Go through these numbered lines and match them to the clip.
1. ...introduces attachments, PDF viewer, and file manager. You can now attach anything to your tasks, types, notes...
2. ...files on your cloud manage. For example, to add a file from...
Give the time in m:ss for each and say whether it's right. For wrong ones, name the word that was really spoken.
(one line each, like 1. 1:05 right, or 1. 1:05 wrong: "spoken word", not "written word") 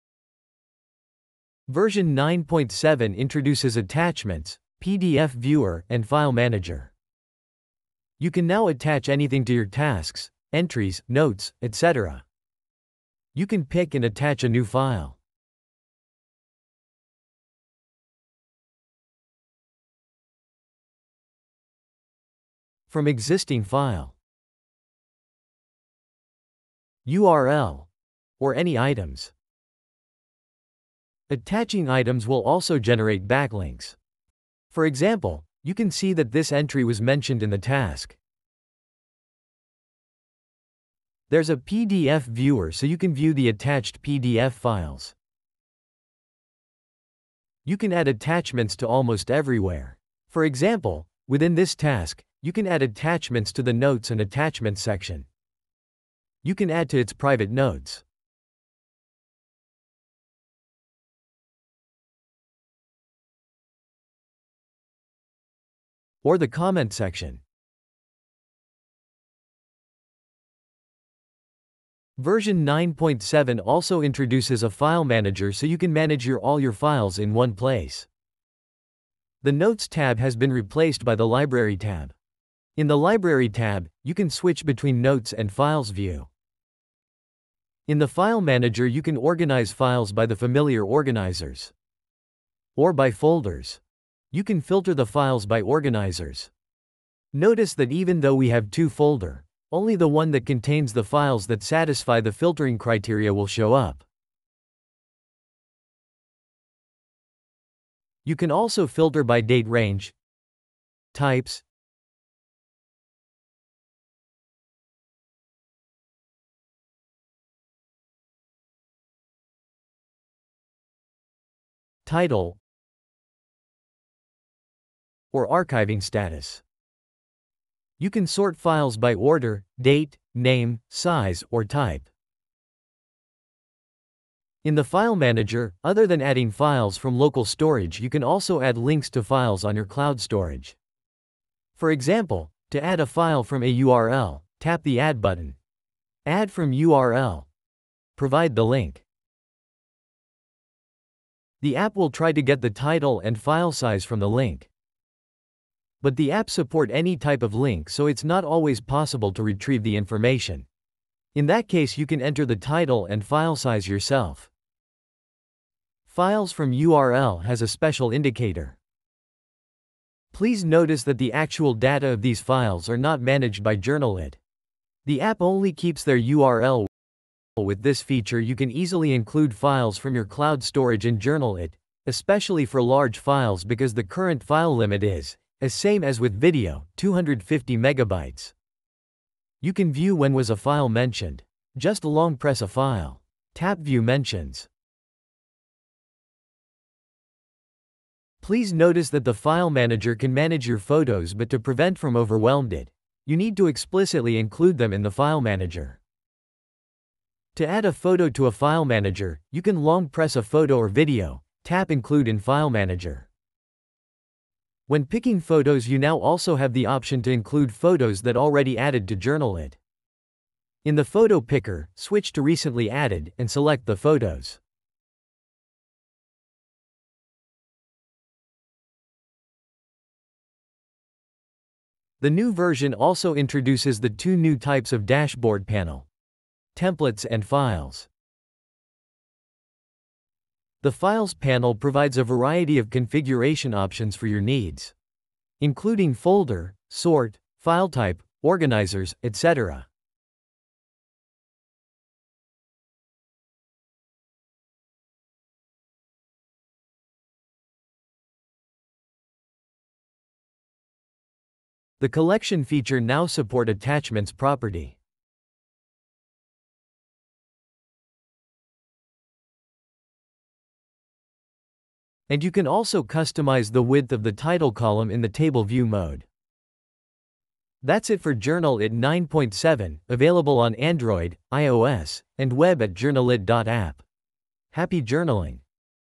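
1. 0:03 wrong: "entries", not "types"
2. 2:19 wrong: "storage", not "manage".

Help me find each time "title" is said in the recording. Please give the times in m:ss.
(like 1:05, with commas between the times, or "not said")
2:02, 2:32, 2:42, 4:34.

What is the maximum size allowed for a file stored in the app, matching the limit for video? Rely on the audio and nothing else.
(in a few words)
250 megabytes.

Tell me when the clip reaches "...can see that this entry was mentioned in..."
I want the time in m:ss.
0:35.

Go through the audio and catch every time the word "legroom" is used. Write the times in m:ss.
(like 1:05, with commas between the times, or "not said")
not said.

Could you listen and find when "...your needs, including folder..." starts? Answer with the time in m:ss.
4:04.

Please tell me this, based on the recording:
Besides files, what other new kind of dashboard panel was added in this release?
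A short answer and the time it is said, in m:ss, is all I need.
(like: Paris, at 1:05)
templates, at 3:56.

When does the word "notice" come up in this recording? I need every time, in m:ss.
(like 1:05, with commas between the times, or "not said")
1:37, 2:50, 3:18.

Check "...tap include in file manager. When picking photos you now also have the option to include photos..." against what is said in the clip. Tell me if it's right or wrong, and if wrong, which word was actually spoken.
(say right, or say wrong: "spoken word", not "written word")
right.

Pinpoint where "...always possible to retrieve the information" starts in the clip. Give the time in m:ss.
2:38.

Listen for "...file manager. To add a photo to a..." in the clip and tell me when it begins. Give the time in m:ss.
3:25.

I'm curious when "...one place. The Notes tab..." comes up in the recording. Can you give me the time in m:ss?
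1:17.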